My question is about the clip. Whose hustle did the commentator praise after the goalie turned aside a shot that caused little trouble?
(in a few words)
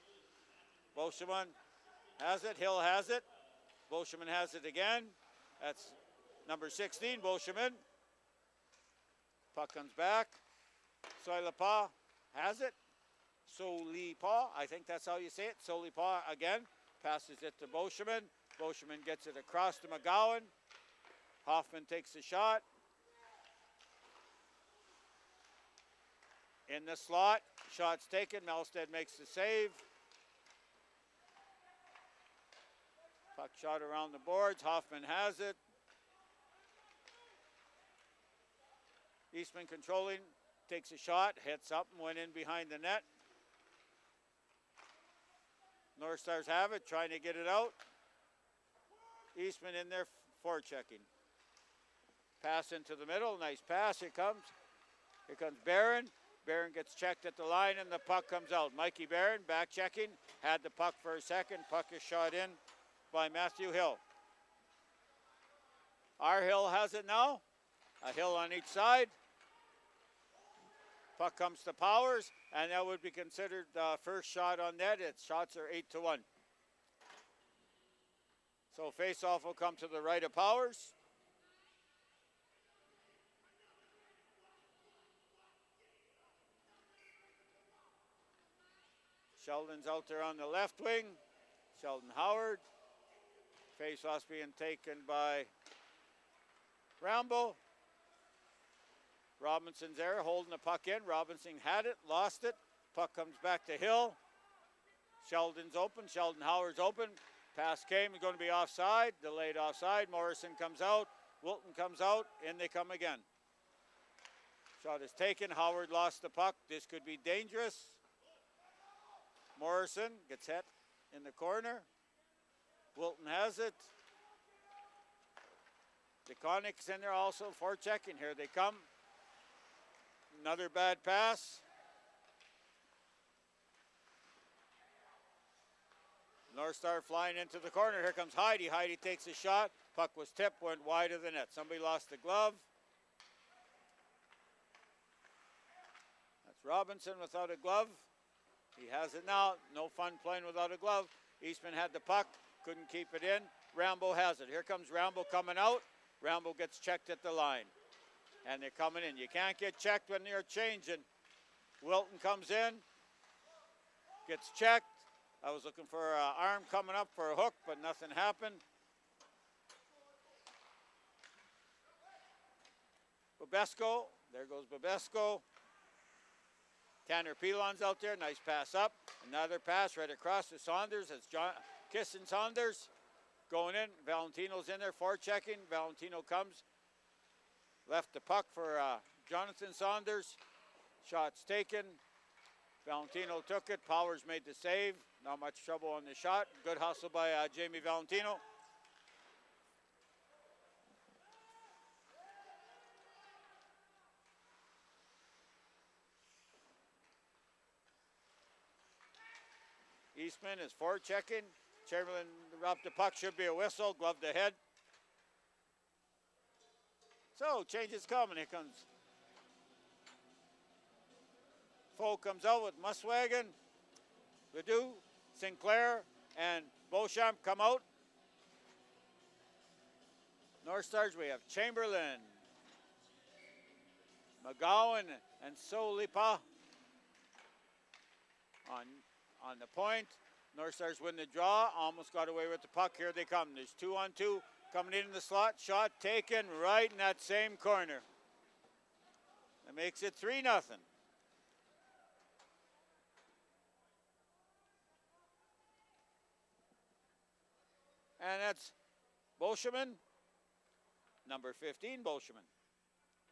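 Jamie Valentino.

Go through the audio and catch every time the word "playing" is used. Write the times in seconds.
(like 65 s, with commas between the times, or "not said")
150 s.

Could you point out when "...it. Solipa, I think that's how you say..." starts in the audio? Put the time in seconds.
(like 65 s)
12 s.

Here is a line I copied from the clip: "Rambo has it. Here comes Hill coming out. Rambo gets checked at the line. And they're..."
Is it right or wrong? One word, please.
wrong.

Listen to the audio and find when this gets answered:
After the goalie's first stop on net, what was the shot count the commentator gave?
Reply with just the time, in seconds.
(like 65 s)
75 s.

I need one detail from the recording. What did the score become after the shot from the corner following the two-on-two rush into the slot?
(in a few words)
3-0.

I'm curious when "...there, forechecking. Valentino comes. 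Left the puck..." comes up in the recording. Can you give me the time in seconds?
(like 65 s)
184 s.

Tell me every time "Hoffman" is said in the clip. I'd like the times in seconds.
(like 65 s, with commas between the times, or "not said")
21 s, 34 s.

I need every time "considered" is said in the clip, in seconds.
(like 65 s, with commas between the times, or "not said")
73 s.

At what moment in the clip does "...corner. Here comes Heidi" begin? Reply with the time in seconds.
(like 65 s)
137 s.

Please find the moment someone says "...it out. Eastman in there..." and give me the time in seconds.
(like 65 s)
47 s.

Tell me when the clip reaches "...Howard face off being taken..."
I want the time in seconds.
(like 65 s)
92 s.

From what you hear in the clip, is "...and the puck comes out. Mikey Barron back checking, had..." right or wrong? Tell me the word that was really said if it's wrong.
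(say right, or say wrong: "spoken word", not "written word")
right.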